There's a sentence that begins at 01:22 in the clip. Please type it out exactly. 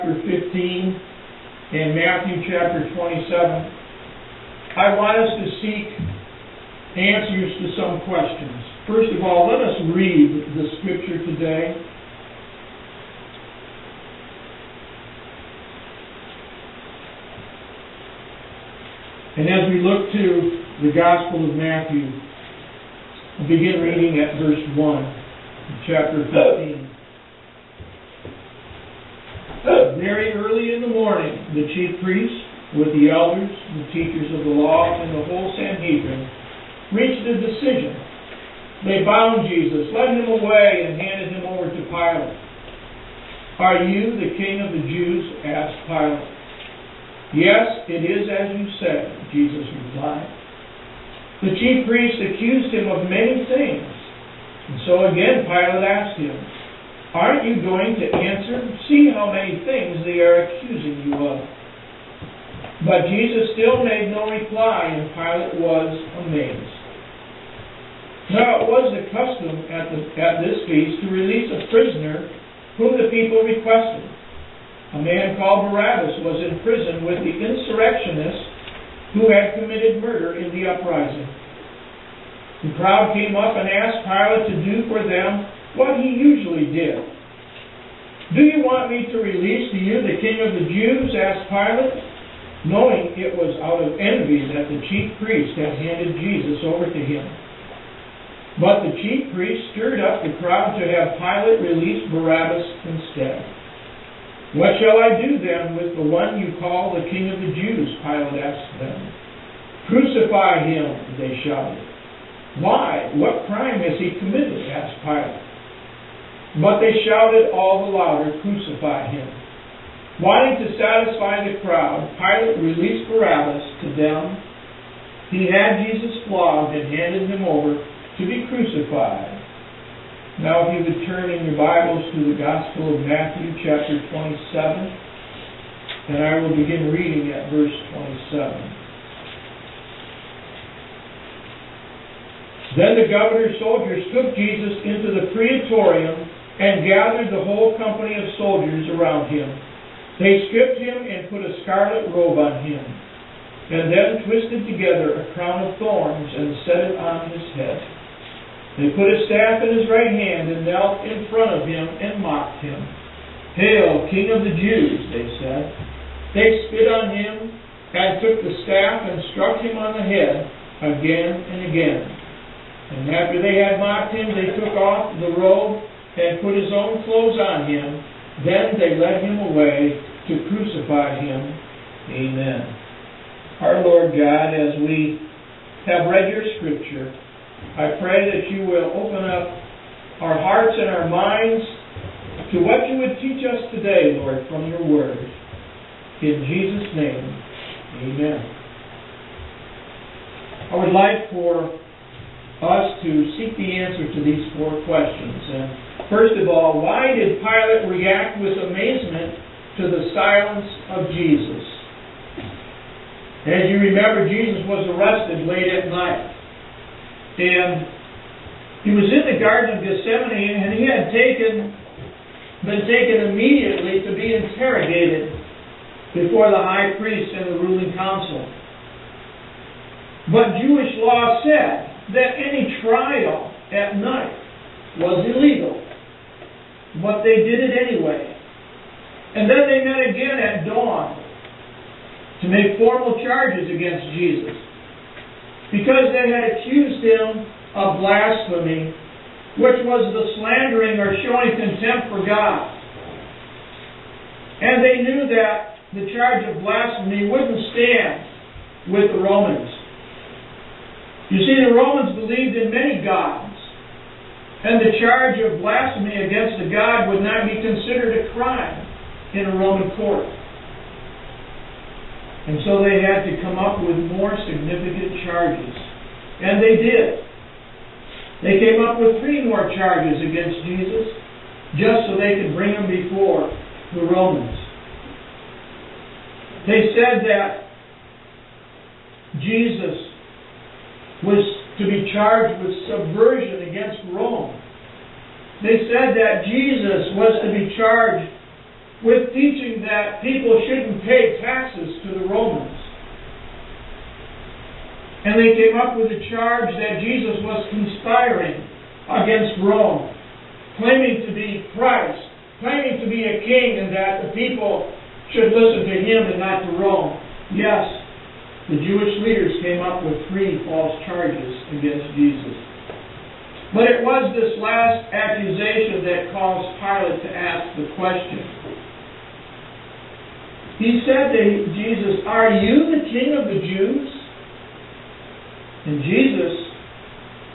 The crowd came up and asked Pilate to do for them what he usually did.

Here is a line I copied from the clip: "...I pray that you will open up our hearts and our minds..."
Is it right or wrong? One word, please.
right.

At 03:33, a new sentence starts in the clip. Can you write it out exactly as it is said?
As you remember, Jesus was arrested late at night.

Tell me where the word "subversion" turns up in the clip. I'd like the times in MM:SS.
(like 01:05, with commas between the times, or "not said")
04:52.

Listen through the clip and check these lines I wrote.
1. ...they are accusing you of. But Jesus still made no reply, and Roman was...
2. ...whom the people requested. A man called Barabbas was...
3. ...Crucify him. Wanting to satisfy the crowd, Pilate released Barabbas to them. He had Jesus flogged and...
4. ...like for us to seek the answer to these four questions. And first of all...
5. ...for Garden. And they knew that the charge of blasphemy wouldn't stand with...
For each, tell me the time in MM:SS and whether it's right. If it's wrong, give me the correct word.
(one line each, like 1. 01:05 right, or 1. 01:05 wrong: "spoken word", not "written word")
1. 01:00 wrong: "Pilate", not "Roman"
2. 01:12 right
3. 01:58 right
4. 03:20 right
5. 04:12 wrong: "God", not "Garden".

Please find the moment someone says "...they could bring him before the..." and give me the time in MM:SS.
04:42.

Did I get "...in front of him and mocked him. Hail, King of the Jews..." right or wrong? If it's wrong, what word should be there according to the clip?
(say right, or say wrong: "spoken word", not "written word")
right.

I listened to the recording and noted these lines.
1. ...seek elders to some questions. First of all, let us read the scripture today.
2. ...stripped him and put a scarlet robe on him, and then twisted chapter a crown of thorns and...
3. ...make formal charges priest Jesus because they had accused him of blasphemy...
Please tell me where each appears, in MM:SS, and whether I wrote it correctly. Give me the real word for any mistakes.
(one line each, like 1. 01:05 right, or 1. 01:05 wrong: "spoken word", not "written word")
1. 00:05 wrong: "answers", not "elders"
2. 02:30 wrong: "together", not "chapter"
3. 04:02 wrong: "against", not "priest".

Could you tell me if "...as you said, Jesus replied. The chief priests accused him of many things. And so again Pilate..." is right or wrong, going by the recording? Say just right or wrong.
right.